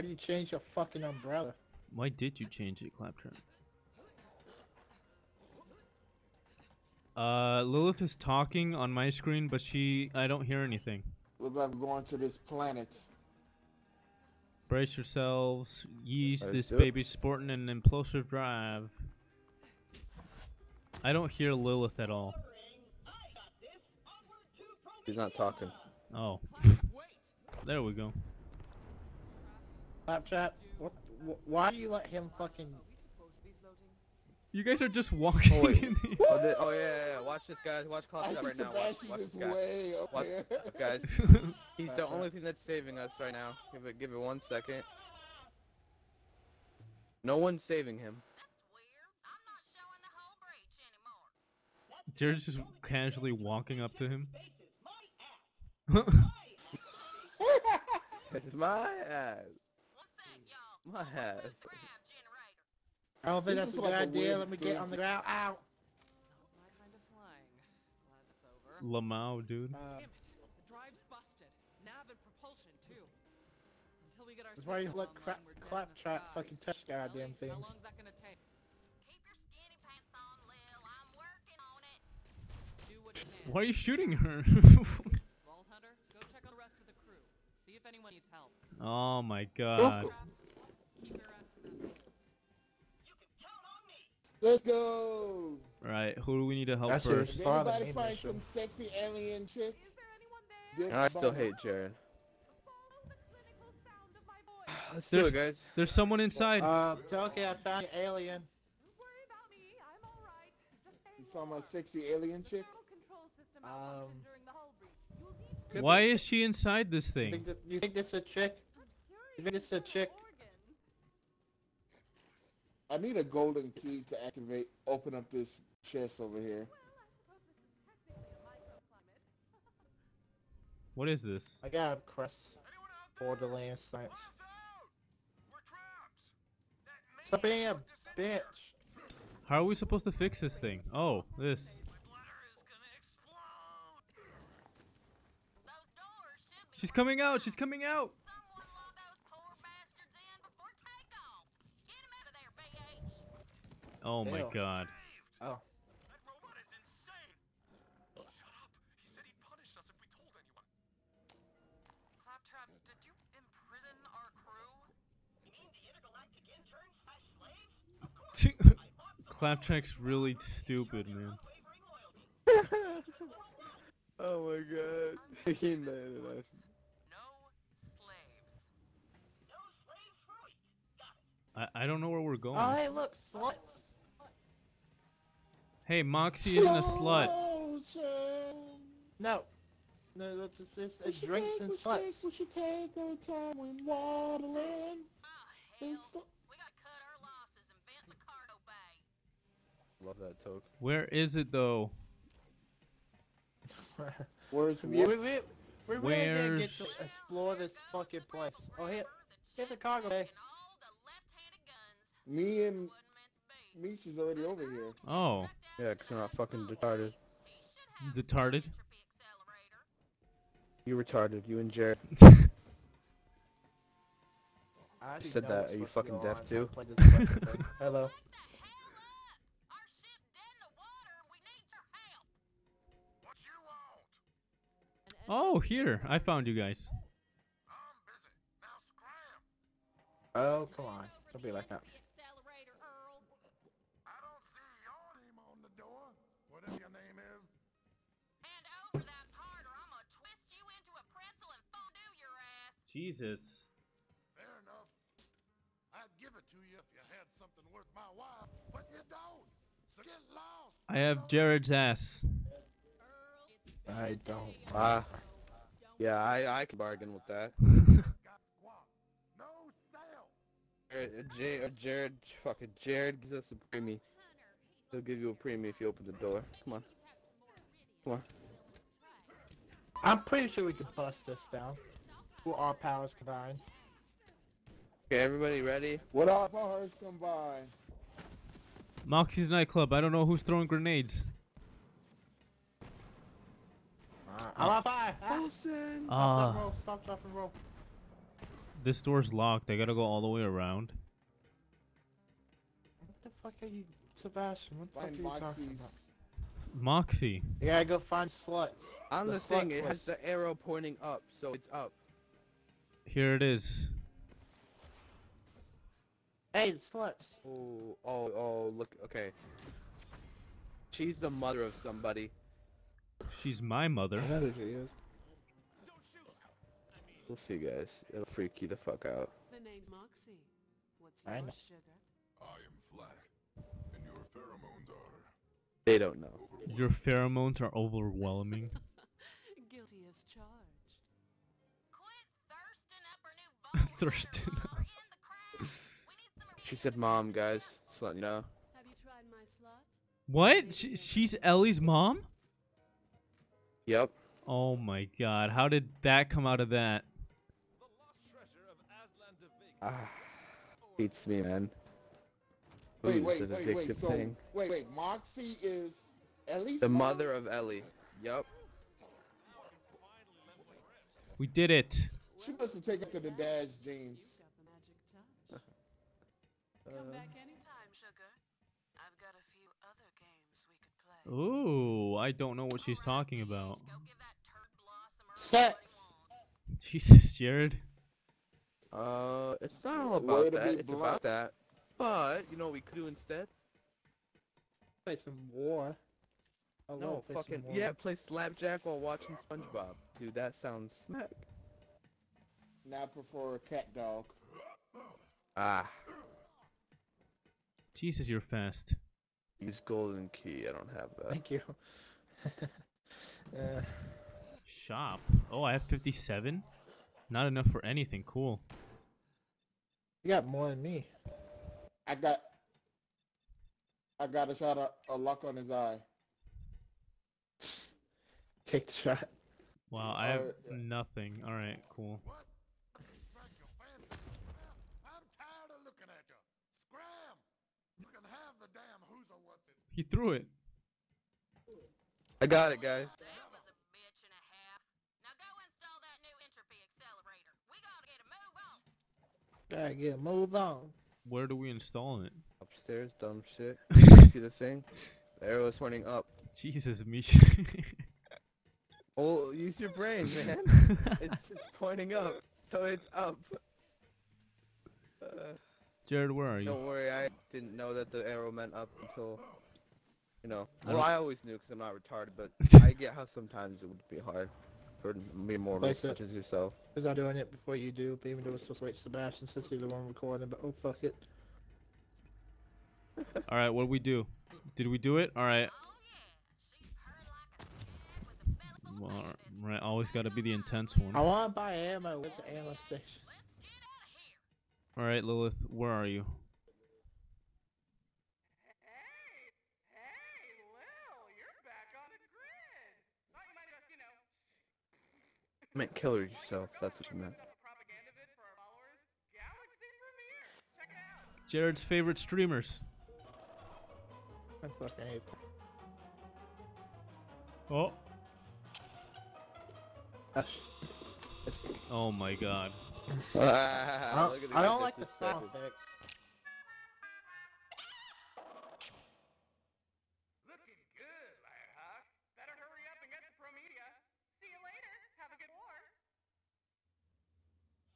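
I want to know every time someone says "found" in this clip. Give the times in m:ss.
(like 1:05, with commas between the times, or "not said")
1:47, 3:56.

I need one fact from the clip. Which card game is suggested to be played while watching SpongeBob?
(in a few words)
slapjack.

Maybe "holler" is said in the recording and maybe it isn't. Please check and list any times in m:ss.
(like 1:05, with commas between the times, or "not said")
not said.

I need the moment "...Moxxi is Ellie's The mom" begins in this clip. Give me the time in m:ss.
6:04.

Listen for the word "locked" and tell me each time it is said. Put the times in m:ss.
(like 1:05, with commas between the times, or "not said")
4:59.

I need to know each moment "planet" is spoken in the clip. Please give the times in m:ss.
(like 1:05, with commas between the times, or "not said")
0:12.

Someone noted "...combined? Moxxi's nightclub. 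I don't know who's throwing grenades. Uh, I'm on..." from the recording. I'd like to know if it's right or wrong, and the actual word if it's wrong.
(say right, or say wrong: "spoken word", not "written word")
right.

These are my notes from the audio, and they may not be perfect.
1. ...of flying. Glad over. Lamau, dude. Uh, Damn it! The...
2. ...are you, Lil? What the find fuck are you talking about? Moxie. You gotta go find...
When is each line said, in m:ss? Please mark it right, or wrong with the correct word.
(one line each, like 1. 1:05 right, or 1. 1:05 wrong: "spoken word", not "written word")
1. 1:06 right
2. 5:03 wrong: "Sebastian", not "Lil".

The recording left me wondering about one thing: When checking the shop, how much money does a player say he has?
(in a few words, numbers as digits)
57.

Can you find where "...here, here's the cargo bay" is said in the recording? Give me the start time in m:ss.
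3:28.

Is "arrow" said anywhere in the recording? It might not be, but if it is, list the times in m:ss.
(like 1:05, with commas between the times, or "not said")
5:10, 7:35, 7:48.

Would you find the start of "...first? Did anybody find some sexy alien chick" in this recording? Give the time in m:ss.
1:37.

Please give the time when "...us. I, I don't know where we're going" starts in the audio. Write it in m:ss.
2:56.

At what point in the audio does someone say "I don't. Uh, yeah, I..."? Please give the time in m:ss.
4:23.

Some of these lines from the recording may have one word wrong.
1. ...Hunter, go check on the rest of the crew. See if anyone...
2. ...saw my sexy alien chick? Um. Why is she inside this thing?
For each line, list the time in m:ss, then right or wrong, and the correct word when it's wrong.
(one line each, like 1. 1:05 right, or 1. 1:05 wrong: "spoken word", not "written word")
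1. 1:25 right
2. 1:51 right.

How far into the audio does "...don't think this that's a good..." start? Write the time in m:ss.
1:03.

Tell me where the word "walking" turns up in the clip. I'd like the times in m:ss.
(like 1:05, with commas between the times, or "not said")
0:35, 0:53.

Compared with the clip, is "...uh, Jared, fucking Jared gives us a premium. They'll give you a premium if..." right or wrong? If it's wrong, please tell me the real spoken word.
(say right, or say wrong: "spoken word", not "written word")
right.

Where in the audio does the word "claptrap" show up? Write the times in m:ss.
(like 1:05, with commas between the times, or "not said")
0:02, 1:15, 2:42, 2:49.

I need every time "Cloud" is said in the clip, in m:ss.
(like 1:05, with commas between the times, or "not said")
0:38.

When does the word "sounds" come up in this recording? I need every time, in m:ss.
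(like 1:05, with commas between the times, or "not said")
6:40.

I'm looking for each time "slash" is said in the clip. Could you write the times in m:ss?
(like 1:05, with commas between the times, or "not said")
2:46.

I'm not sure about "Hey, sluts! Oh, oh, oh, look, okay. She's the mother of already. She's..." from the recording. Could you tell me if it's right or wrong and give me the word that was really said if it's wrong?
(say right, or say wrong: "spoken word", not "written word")
wrong: "somebody", not "already".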